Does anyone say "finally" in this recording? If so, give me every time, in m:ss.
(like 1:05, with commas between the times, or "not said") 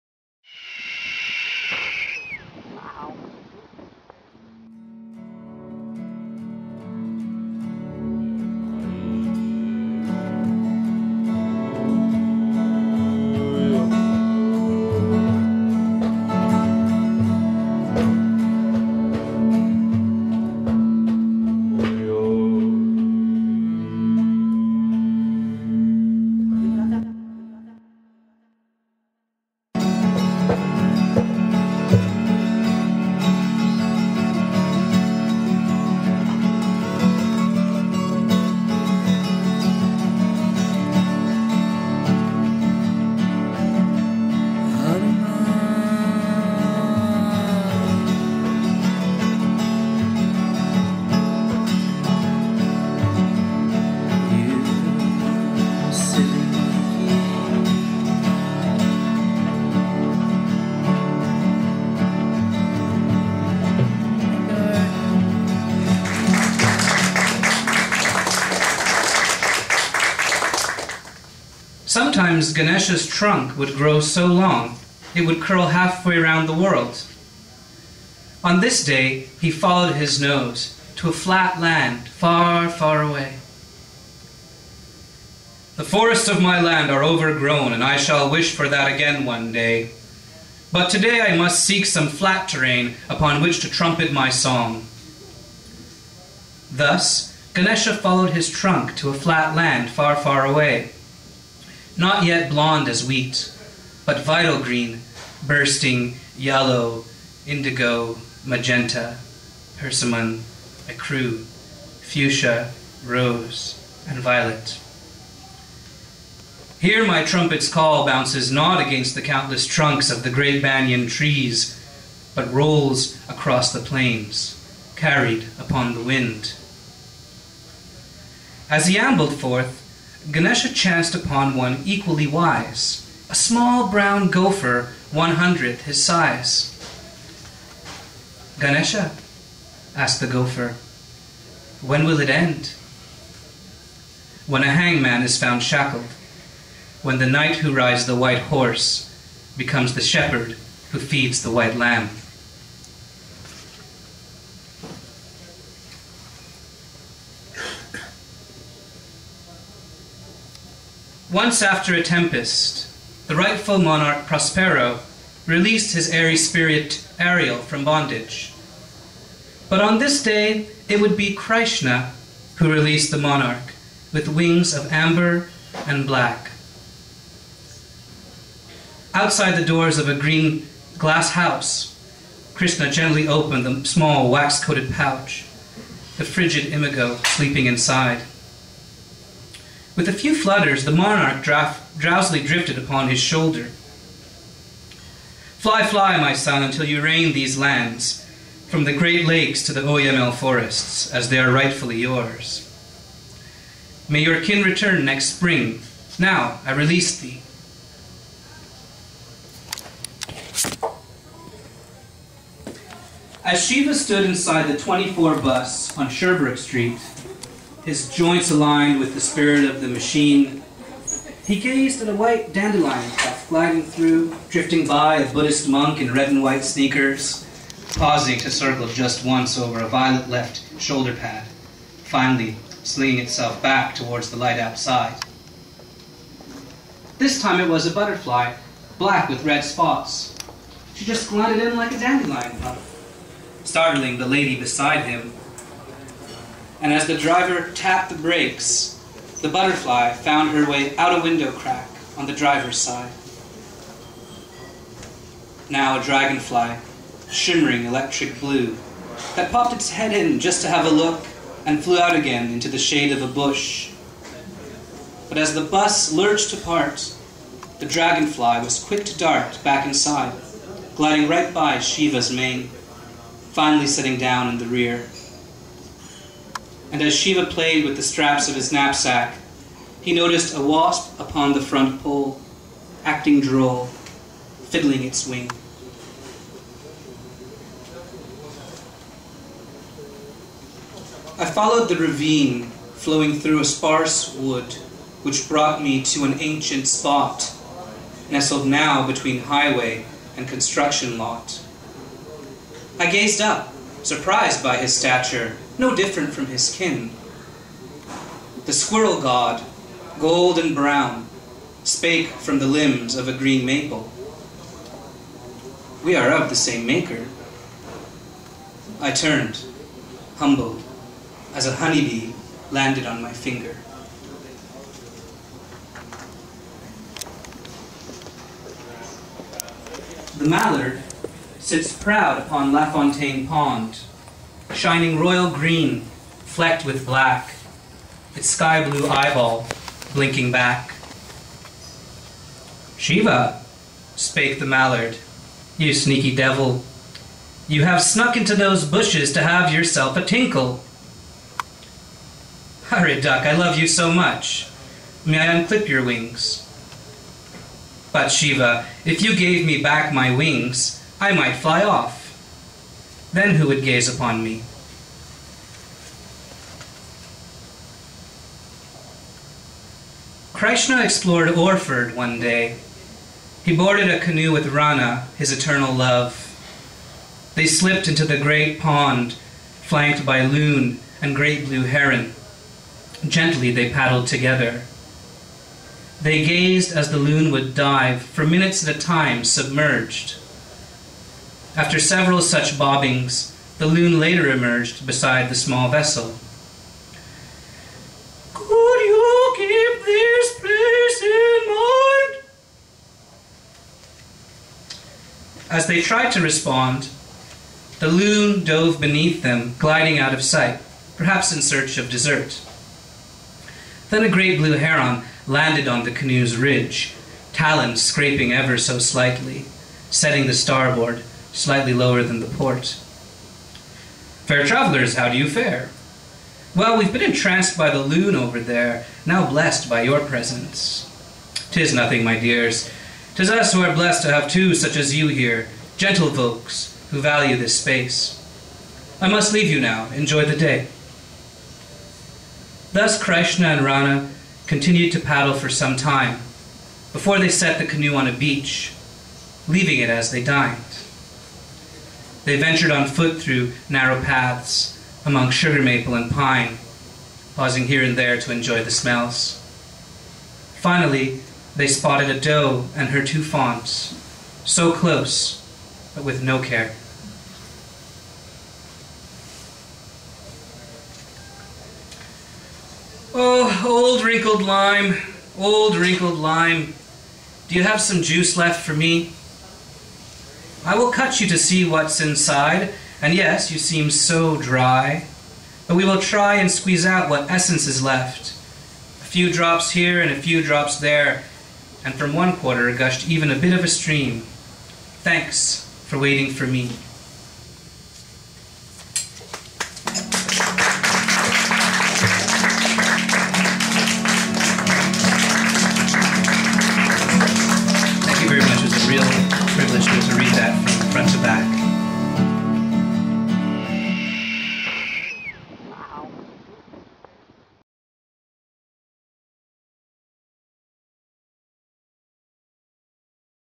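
3:52, 4:33, 7:40.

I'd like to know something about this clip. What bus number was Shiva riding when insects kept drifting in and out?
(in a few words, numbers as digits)
24.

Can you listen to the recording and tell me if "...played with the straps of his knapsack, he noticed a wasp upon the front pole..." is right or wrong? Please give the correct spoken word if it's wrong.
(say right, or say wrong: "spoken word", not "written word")
right.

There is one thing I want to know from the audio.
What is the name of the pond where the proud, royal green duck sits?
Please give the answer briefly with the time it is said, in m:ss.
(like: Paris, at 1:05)
La Fontaine Pond, at 5:32.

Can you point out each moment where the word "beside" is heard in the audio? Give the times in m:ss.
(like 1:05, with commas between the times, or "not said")
4:04, 6:35.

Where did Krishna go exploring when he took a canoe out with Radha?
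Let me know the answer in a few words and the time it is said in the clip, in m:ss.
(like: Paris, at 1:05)
Orford, at 6:11.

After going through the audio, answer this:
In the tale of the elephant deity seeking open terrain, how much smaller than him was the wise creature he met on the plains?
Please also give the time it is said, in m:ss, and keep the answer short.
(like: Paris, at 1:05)
one hundredth his size, at 2:15.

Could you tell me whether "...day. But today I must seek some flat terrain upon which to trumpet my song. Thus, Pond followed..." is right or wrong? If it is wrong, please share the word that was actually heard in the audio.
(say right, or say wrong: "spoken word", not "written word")
wrong: "Ganesha", not "Pond".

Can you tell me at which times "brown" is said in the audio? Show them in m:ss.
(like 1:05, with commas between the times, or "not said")
2:13, 5:10.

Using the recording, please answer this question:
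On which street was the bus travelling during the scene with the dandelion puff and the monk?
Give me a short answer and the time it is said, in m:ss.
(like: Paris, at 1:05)
Sherbrooke Street, at 3:36.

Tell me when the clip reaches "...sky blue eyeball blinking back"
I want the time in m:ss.
5:38.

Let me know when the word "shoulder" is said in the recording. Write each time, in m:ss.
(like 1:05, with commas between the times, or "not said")
3:13, 3:50.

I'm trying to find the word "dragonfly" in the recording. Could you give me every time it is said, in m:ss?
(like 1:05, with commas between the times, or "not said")
4:16, 4:27.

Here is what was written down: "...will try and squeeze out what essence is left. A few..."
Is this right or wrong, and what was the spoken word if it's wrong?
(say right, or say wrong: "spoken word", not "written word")
right.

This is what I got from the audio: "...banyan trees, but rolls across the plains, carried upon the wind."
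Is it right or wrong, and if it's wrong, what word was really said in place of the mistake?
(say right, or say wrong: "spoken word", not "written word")
right.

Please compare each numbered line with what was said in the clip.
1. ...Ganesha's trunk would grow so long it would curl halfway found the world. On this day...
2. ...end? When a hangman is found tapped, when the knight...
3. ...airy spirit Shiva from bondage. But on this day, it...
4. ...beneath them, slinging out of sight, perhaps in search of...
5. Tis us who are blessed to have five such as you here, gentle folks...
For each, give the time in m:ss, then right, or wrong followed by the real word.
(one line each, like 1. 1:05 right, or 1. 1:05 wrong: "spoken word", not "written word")
1. 1:12 wrong: "round", not "found"
2. 2:22 wrong: "shackled", not "tapped"
3. 2:46 wrong: "Ariel", not "Shiva"
4. 6:48 wrong: "gliding", not "slinging"
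5. 7:13 wrong: "two", not "five".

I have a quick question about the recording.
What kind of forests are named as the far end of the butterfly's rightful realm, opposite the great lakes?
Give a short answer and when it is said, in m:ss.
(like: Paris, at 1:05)
Oyamel forests, at 3:19.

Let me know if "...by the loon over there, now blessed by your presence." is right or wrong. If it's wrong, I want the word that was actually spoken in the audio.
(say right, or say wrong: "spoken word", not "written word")
right.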